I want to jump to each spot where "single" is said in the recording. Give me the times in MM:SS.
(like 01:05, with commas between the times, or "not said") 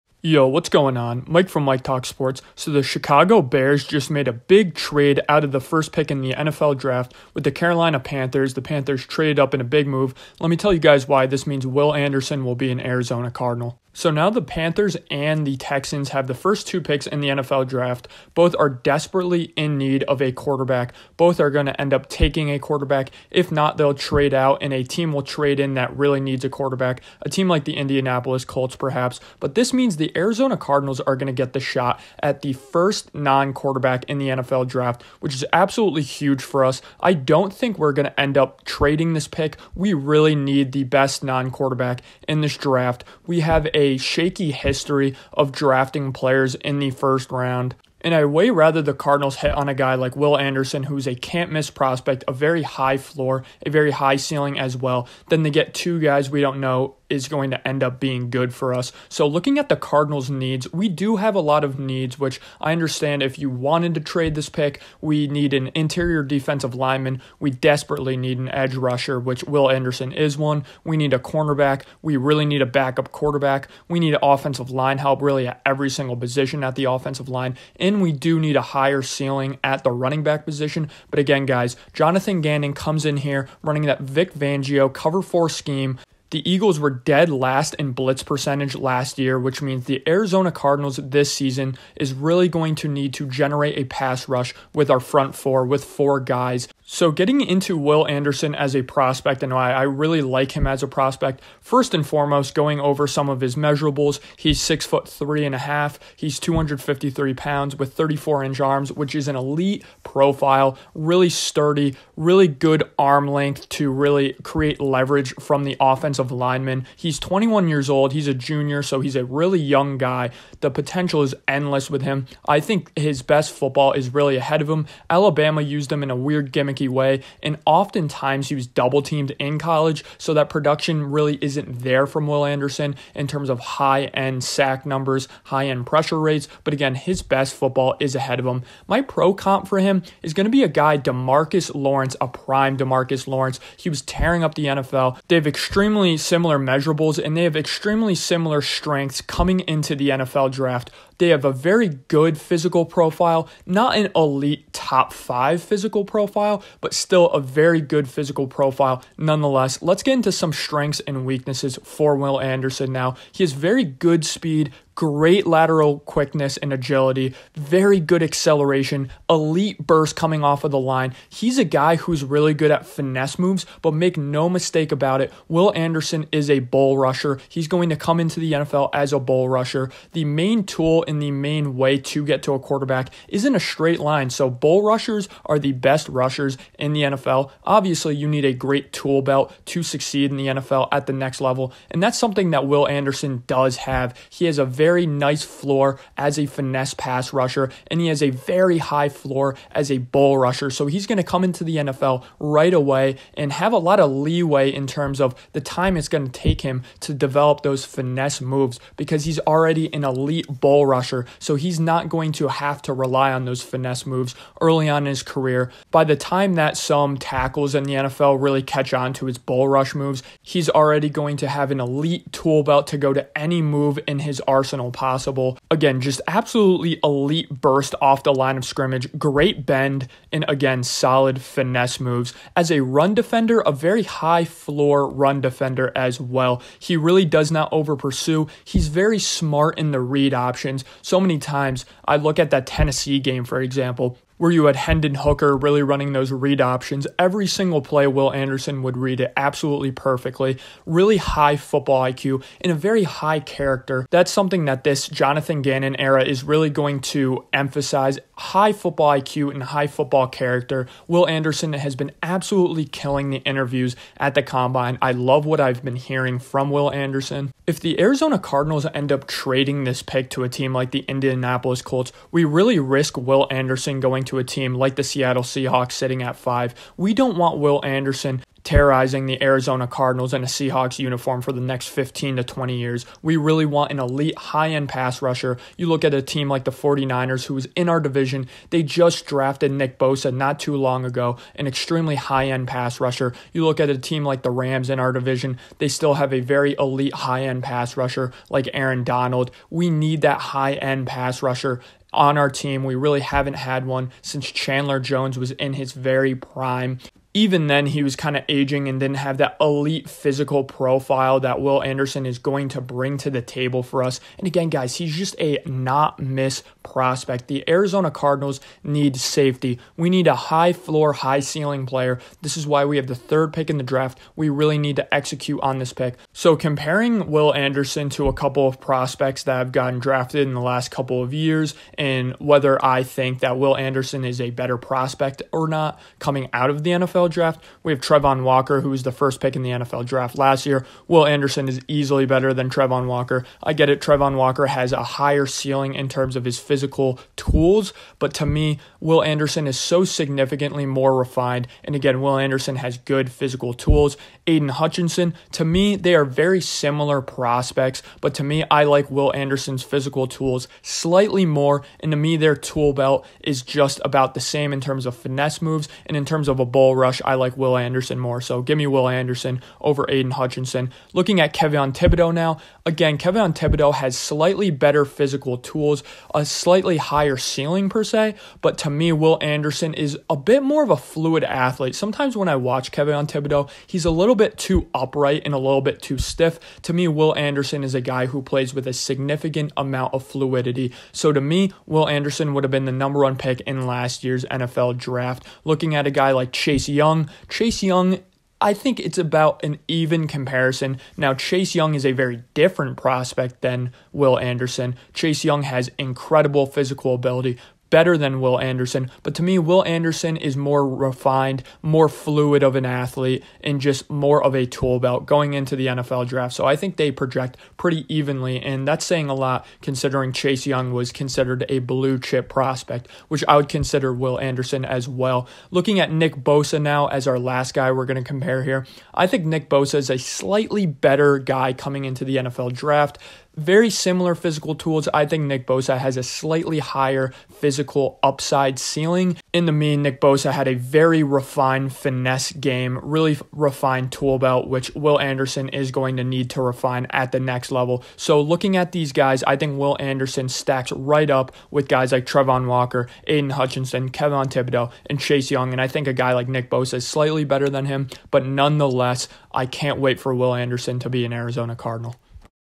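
01:15, 04:07.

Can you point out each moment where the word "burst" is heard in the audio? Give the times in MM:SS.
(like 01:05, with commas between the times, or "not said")
02:49, 03:47.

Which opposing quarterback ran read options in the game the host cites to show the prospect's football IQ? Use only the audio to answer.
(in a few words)
Hendon Hooker.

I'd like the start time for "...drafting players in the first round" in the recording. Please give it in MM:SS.
00:45.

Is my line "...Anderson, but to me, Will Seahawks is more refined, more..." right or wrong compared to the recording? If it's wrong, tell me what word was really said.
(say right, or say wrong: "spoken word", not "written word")
wrong: "Anderson", not "Seahawks".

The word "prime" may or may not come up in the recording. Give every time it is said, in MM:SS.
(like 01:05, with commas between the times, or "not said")
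02:22, 05:06.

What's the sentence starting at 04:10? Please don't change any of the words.
Really high football IQ and a very high character.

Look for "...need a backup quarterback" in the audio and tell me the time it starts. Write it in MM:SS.
01:12.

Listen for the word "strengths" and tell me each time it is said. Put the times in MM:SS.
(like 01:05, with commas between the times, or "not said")
02:28, 02:40.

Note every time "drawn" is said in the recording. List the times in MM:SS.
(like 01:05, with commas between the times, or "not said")
not said.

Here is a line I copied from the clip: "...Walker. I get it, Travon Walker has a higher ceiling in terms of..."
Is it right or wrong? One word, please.
right.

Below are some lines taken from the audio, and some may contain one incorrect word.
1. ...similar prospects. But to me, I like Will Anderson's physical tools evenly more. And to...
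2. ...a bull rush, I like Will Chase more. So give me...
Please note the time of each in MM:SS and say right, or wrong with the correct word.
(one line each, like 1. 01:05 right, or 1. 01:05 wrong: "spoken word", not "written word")
1. 05:56 wrong: "slightly", not "evenly"
2. 06:06 wrong: "Anderson", not "Chase".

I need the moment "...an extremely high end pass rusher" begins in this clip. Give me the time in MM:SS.
04:51.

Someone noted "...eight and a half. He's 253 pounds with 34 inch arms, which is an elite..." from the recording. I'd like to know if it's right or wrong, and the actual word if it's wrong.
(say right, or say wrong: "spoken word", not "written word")
wrong: "three", not "eight".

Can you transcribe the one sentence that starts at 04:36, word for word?
We don't want Will Anderson terrorizing the Arizona Cardinals in a Seahawks uniform for the next 15 to 20 years.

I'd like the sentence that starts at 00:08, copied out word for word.
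The Panthers traded up in a big move.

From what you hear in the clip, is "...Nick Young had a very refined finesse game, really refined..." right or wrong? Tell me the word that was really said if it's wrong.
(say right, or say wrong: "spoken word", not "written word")
wrong: "Bosa", not "Young".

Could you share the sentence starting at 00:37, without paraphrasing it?
I don't think we're going to end up trading this pick.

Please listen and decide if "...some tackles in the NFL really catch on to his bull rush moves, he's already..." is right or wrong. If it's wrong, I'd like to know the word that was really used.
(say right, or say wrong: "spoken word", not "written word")
right.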